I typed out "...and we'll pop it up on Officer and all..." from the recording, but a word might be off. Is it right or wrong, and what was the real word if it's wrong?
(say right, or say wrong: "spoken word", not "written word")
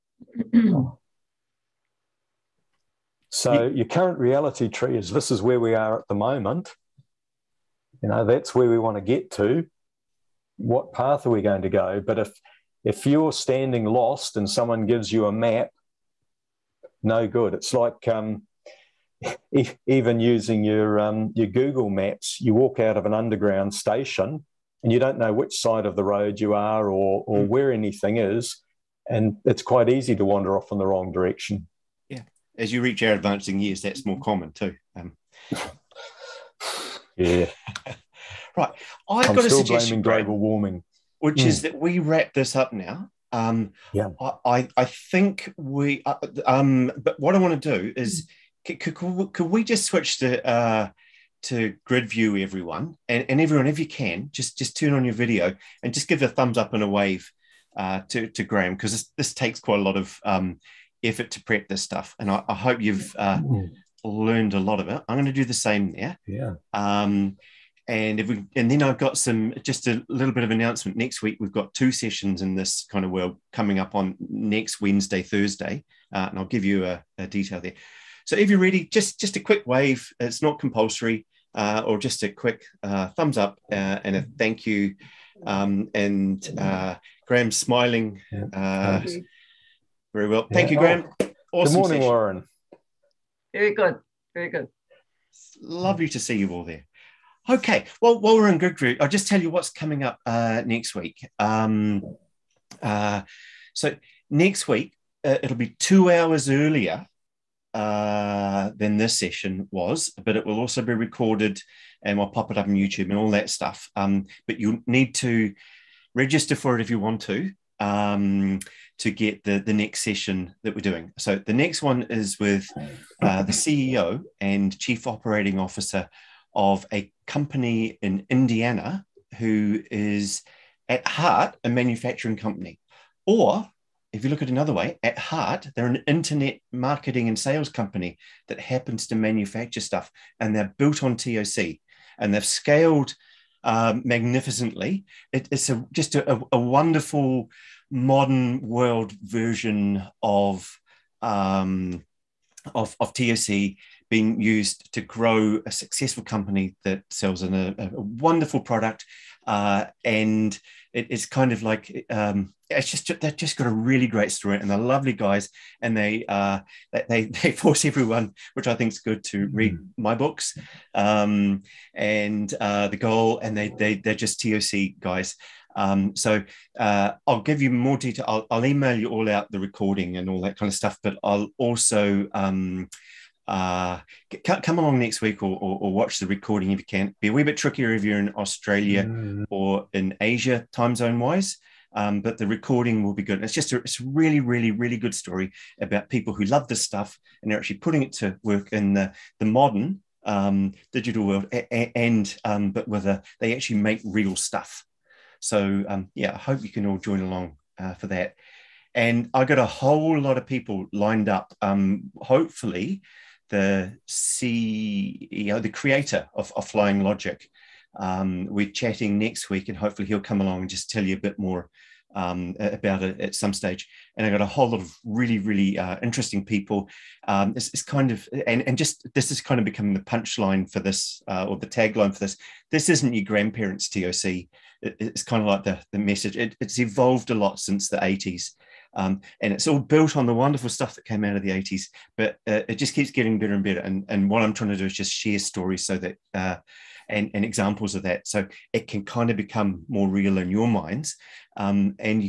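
wrong: "YouTube", not "Officer".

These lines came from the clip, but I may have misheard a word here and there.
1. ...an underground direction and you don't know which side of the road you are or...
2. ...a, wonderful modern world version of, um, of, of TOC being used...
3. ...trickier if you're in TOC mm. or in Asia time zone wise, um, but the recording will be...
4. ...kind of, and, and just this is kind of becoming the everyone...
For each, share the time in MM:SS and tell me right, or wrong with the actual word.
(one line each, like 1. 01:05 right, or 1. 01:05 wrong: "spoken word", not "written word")
1. 00:23 wrong: "station", not "direction"
2. 02:26 right
3. 03:07 wrong: "Australia", not "TOC"
4. 03:47 wrong: "punchline", not "everyone".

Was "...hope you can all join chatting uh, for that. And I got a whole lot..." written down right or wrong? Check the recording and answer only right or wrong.
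wrong.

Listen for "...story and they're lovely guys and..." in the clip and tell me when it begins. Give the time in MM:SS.
02:44.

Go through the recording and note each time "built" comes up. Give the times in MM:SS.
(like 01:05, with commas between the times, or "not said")
02:20, 03:59.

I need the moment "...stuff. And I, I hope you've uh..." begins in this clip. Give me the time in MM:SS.
01:01.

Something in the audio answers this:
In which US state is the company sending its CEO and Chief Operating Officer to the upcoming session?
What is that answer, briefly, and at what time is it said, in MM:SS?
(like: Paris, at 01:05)
Indiana, at 02:08.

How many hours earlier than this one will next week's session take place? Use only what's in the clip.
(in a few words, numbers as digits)
2.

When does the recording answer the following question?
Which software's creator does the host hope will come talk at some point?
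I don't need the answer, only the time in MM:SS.
03:36.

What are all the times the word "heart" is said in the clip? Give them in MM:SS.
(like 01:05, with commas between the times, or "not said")
02:11, 02:15.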